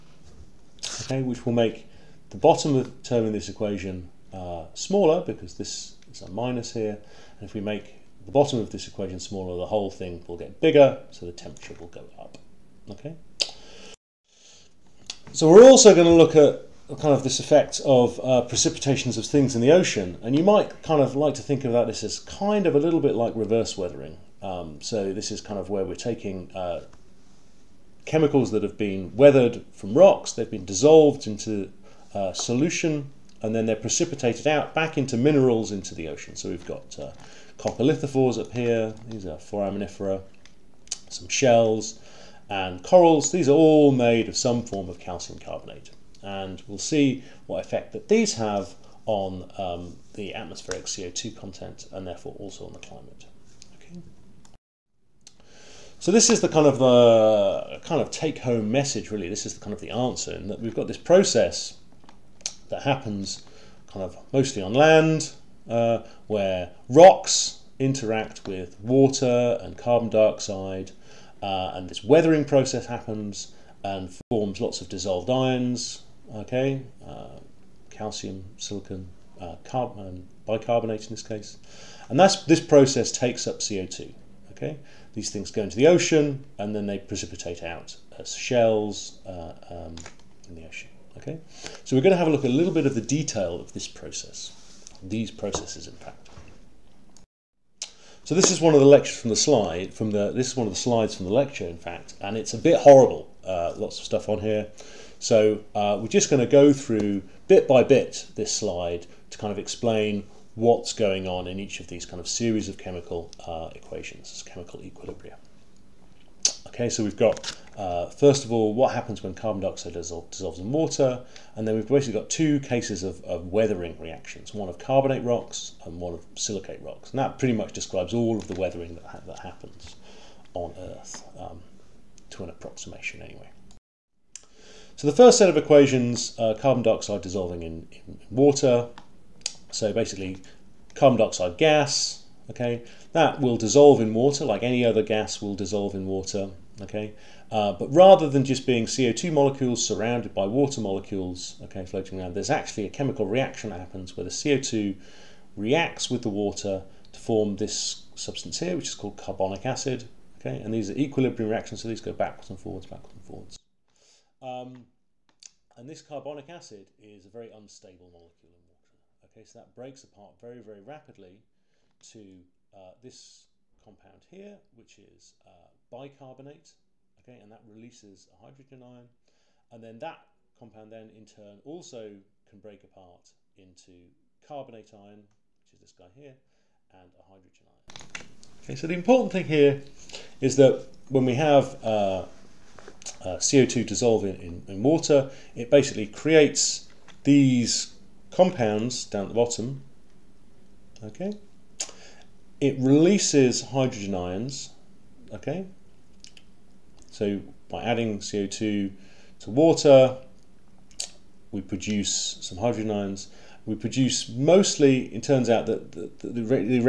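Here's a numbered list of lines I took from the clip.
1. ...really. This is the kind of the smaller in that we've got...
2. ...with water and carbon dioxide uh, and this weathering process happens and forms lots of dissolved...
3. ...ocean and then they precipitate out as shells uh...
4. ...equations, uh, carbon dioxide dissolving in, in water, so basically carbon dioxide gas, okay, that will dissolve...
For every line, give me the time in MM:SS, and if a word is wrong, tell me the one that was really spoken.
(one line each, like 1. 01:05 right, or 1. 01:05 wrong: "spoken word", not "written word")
1. 00:59 wrong: "answer", not "smaller"
2. 01:08 right
3. 01:25 right
4. 02:15 right.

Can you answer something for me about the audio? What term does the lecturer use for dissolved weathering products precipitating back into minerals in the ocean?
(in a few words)
reverse weathering.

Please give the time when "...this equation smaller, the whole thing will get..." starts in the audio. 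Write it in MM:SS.
00:08.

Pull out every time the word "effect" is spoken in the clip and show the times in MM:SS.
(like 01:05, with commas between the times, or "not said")
00:17, 00:47.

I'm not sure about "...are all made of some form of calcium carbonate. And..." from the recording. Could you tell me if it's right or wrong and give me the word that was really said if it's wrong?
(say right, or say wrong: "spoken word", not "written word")
right.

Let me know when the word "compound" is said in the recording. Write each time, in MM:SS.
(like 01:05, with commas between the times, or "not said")
02:53, 03:00, 03:18.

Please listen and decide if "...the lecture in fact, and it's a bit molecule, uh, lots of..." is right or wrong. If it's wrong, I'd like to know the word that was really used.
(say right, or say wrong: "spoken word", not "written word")
wrong: "horrible", not "molecule".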